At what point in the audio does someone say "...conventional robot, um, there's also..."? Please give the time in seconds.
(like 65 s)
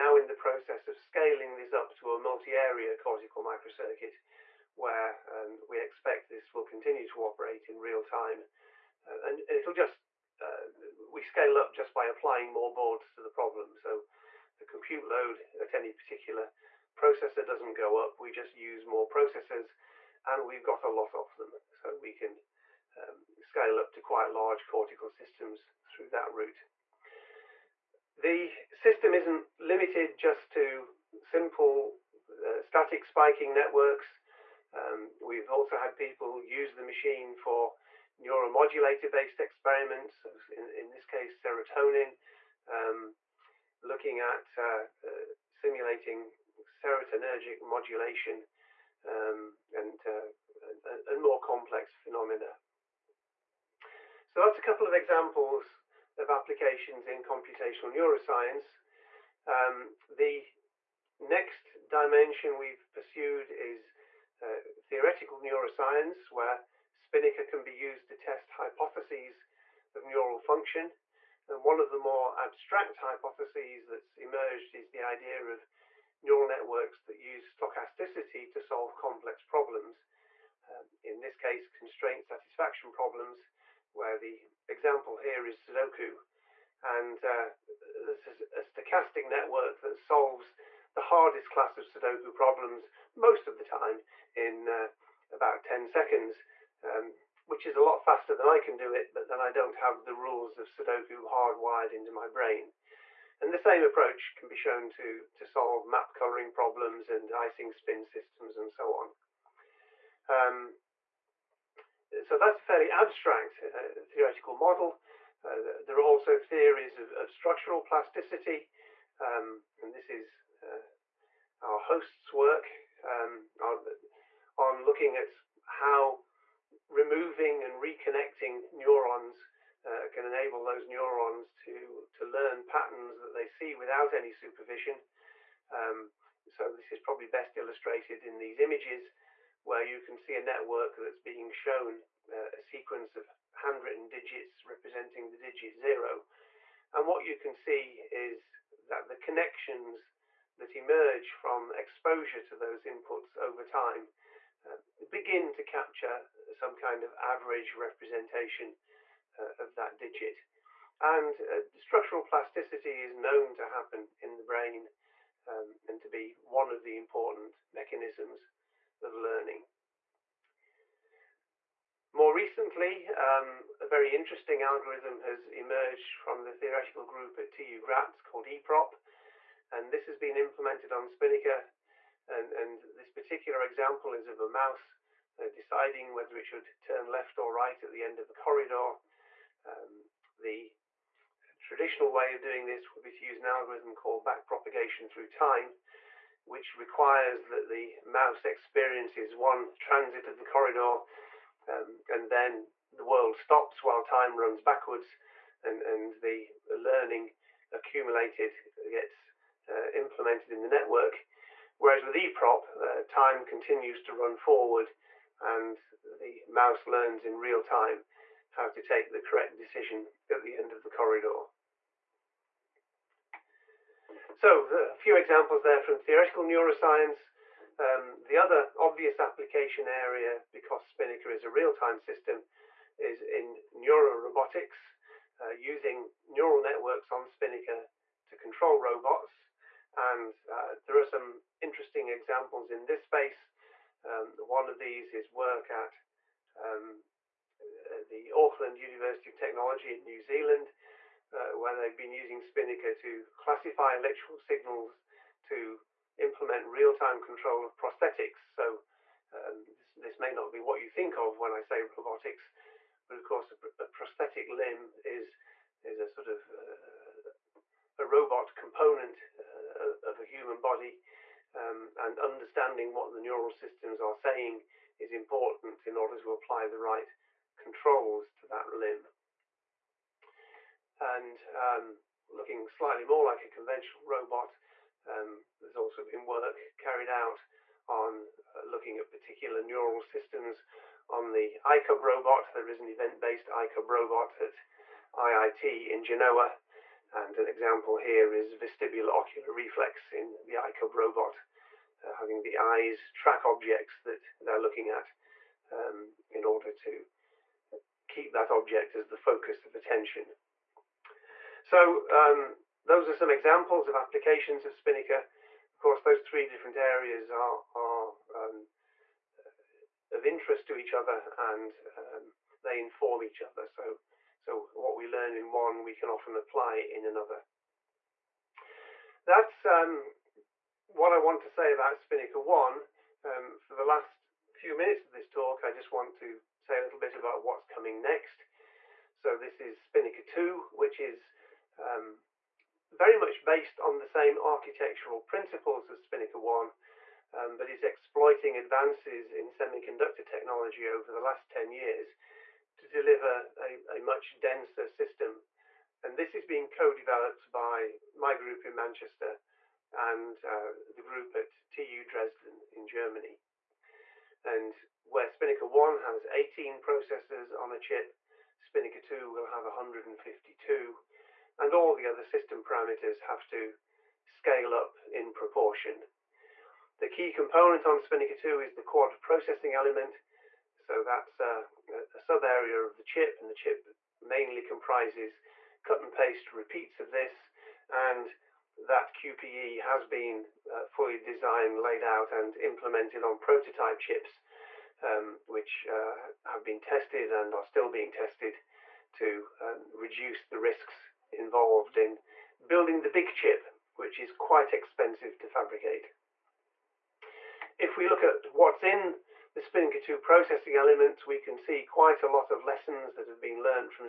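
283 s.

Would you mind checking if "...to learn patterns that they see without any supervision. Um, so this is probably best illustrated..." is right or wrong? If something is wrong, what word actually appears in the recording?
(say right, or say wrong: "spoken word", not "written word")
right.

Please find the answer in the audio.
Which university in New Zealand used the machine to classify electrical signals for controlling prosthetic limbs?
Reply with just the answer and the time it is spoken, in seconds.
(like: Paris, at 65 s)
Auckland University of Technology, at 248 s.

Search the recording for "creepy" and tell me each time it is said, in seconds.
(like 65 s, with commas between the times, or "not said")
not said.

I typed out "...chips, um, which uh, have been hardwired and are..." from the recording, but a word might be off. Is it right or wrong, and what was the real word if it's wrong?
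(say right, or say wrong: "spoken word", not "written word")
wrong: "tested", not "hardwired".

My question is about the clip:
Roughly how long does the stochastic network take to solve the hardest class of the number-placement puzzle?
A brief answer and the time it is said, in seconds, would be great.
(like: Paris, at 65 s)
10 seconds, at 95 s.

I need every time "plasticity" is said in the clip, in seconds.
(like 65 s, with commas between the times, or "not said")
117 s, 162 s.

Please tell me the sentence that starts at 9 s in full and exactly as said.
Uh, and it'll just uh, we scale up just by applying more boards to the problem.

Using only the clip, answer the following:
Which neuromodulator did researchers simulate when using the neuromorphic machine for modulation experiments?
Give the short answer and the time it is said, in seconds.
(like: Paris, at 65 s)
Serotonin, at 41 s.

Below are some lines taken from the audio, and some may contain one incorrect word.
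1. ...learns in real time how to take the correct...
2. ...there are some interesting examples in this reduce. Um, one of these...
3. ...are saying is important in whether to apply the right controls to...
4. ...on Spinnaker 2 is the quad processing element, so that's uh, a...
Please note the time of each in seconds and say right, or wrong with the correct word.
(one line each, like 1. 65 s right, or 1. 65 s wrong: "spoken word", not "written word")
1. 216 s right
2. 240 s wrong: "space", not "reduce"
3. 274 s wrong: "order", not "whether"
4. 377 s right.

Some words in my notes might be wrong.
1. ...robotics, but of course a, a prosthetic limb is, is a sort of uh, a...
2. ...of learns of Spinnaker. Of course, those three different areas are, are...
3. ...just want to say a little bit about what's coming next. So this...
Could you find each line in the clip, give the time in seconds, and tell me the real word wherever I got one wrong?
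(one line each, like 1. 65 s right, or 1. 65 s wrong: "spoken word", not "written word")
1. 261 s right
2. 313 s wrong: "applications", not "learns"
3. 335 s right.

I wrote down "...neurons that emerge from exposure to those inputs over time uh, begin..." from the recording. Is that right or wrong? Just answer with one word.
wrong.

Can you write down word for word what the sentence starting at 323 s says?
So so what we learn in one, we can often apply in another.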